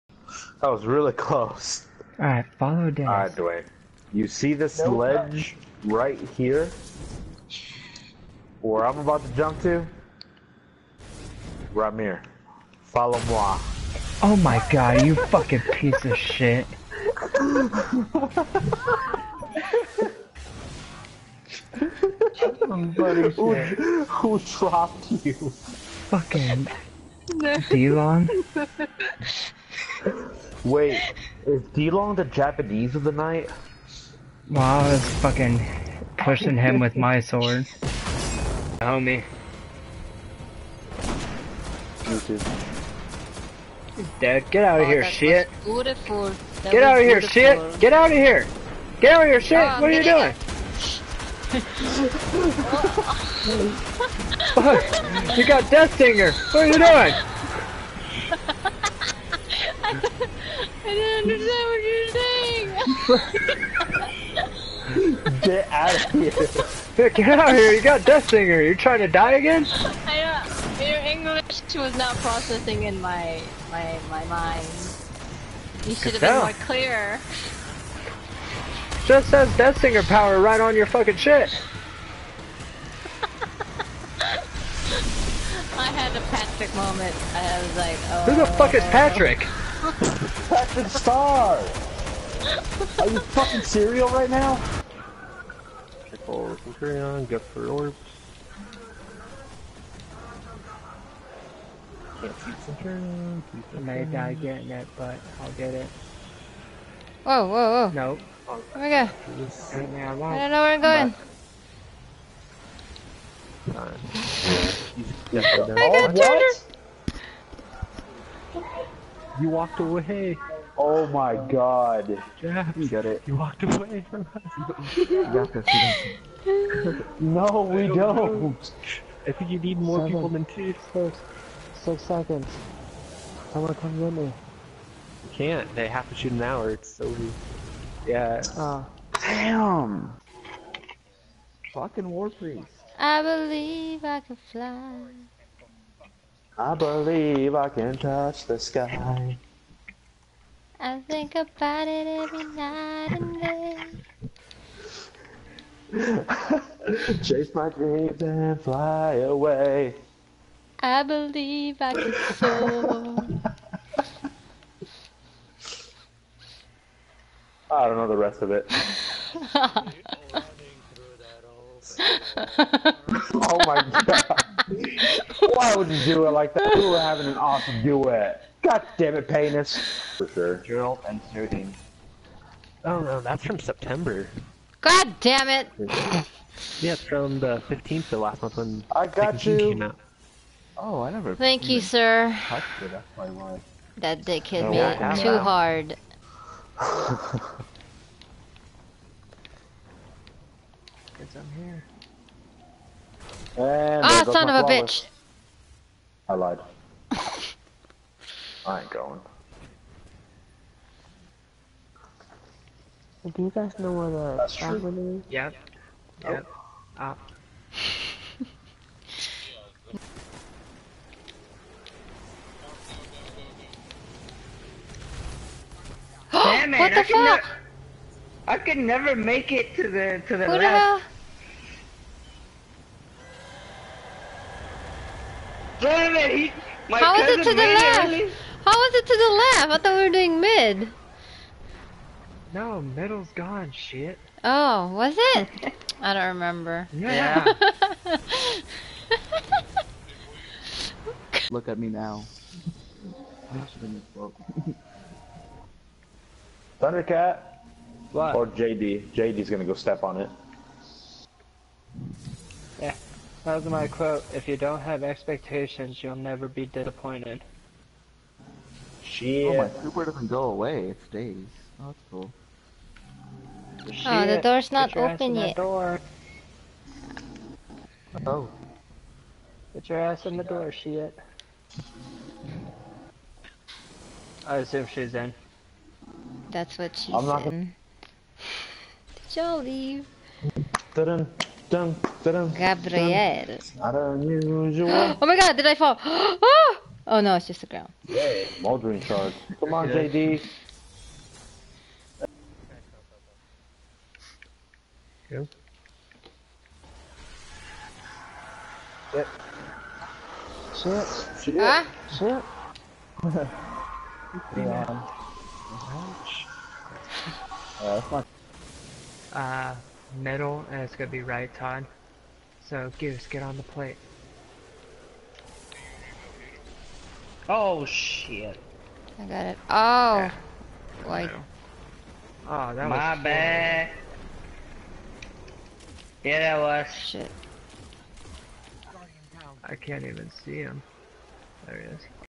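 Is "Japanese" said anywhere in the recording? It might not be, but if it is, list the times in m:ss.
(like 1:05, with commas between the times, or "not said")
0:32.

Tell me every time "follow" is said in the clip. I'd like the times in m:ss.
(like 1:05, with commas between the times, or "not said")
0:02, 0:12.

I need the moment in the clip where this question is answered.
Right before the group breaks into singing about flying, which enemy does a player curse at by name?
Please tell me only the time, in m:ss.
2:22.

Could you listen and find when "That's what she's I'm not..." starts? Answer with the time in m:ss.
4:46.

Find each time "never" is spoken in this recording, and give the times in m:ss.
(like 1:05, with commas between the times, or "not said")
3:11, 3:48, 4:26.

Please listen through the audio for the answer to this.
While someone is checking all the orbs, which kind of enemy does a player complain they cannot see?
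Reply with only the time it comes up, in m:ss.
1:42.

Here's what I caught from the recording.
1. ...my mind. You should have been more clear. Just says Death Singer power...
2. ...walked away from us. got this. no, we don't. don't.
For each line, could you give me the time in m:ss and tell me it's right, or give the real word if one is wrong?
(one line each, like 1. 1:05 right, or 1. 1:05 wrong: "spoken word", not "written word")
1. 1:14 right
2. 2:03 right.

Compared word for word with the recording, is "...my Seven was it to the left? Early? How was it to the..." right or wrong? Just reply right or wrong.
wrong.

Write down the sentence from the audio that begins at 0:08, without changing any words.
Where I'm about to jump to?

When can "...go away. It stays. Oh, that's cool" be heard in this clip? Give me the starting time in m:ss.
4:30.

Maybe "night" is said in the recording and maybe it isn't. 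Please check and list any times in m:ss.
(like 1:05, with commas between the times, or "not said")
0:33, 2:32.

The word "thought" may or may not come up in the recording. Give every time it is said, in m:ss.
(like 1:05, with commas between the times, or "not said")
3:59.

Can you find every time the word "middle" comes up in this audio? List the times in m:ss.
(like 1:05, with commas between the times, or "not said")
4:02, 5:20.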